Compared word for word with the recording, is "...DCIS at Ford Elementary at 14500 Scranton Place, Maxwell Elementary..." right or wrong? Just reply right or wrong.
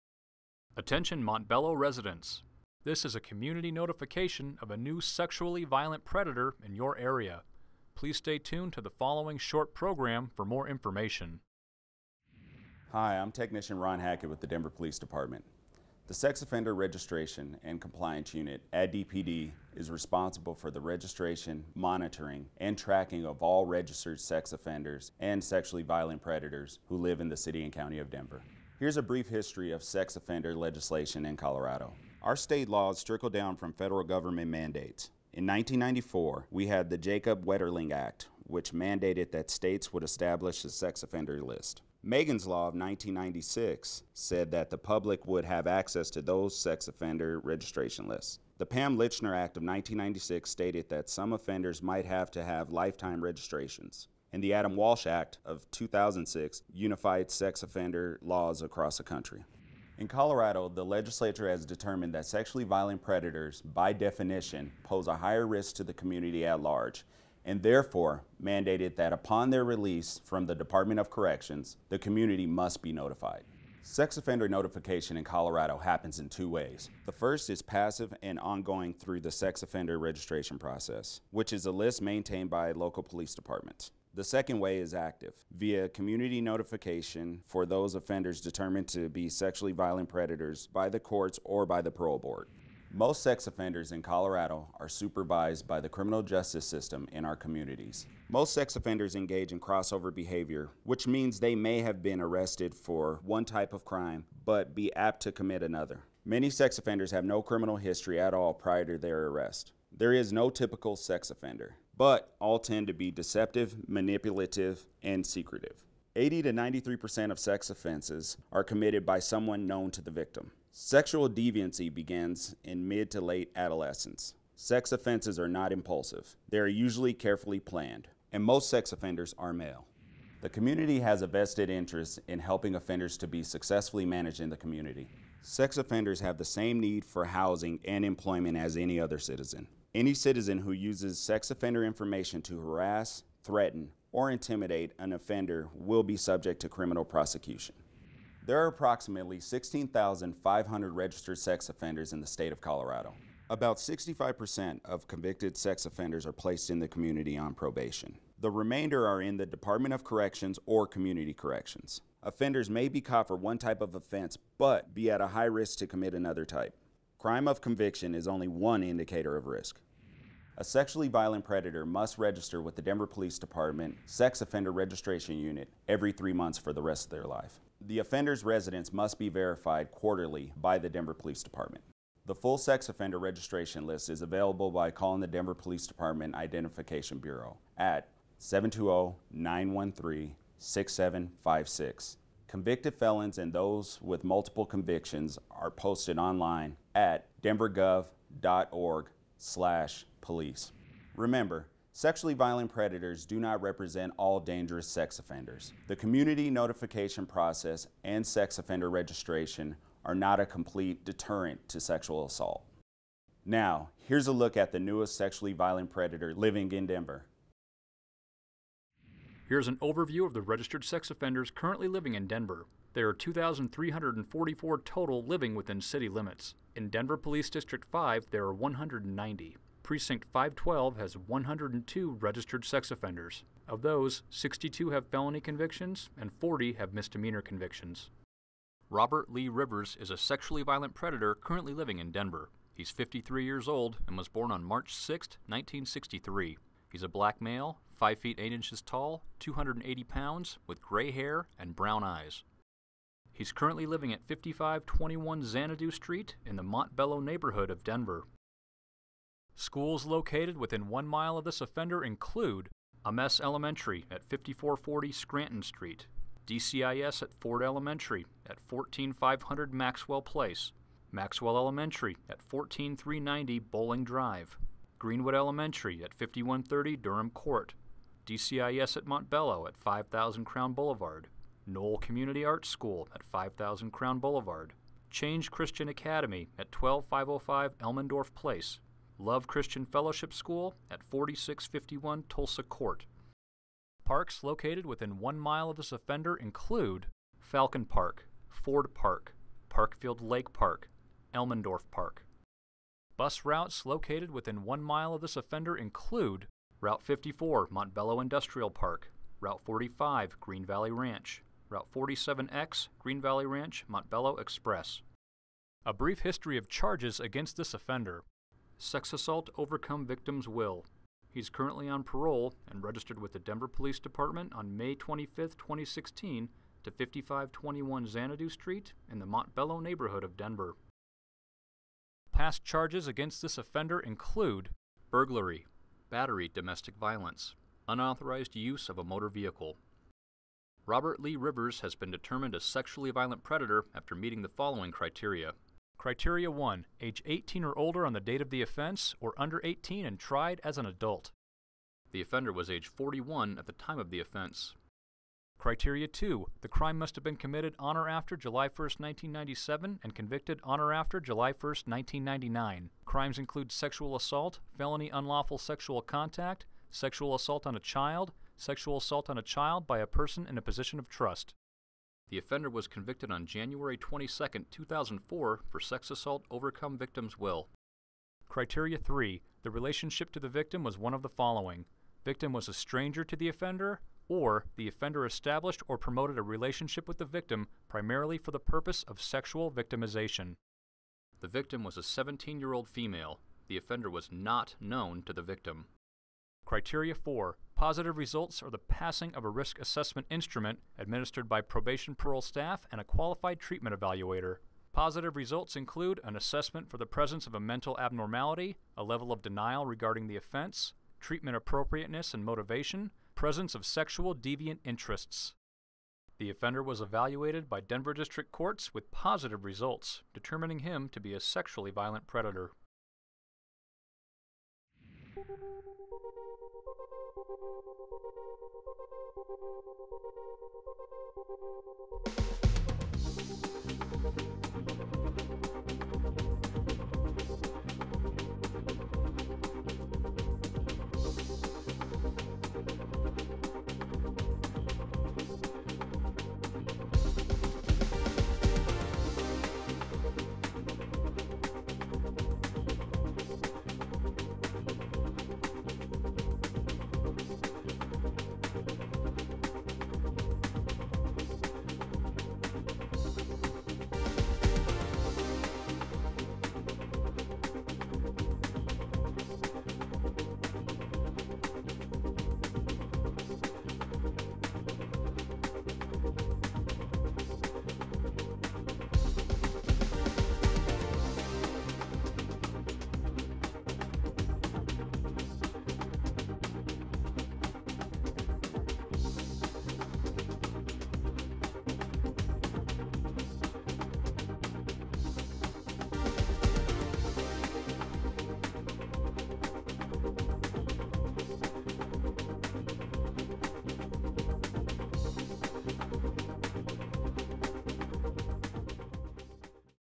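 wrong.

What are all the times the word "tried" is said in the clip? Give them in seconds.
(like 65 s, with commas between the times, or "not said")
350 s.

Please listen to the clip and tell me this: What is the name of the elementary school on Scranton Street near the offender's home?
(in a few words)
Ames Elementary.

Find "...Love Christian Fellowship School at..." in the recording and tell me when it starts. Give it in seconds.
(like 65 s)
289 s.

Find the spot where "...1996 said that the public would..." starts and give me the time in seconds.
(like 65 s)
42 s.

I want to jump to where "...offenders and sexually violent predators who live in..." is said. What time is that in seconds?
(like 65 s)
24 s.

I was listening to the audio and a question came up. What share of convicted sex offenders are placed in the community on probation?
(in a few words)
65%.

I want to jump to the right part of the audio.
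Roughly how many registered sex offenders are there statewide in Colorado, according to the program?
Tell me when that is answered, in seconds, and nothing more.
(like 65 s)
149 s.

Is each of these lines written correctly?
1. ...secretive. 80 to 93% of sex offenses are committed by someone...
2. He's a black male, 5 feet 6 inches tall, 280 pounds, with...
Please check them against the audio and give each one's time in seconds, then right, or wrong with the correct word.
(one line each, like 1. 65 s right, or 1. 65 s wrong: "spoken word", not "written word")
1. 115 s right
2. 246 s wrong: "8", not "6".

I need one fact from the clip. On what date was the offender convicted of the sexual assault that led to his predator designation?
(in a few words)
January 22, 2004.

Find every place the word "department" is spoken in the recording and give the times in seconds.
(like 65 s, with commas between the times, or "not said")
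14 s, 70 s, 83 s, 159 s, 173 s, 181 s, 185 s, 323 s.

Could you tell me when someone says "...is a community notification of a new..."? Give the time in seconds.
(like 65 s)
3 s.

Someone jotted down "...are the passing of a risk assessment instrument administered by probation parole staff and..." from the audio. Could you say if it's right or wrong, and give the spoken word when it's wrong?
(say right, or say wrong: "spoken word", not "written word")
right.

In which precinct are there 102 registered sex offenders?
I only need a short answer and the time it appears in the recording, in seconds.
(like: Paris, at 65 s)
Precinct 512, at 229 s.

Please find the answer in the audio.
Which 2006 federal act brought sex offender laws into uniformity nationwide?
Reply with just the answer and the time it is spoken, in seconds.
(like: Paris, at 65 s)
Adam Walsh Act, at 54 s.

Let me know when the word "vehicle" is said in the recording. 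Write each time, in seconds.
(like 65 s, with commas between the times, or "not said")
339 s.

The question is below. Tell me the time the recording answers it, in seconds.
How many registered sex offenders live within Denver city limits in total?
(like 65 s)
223 s.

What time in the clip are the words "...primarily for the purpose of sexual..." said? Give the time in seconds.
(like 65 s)
387 s.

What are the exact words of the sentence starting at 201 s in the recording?
Remember, sexually violent predators do not represent all dangerous sex offenders.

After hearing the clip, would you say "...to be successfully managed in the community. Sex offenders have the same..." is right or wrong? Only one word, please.
right.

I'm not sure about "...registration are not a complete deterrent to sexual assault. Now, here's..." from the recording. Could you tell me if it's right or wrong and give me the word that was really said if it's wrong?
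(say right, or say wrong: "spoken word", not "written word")
right.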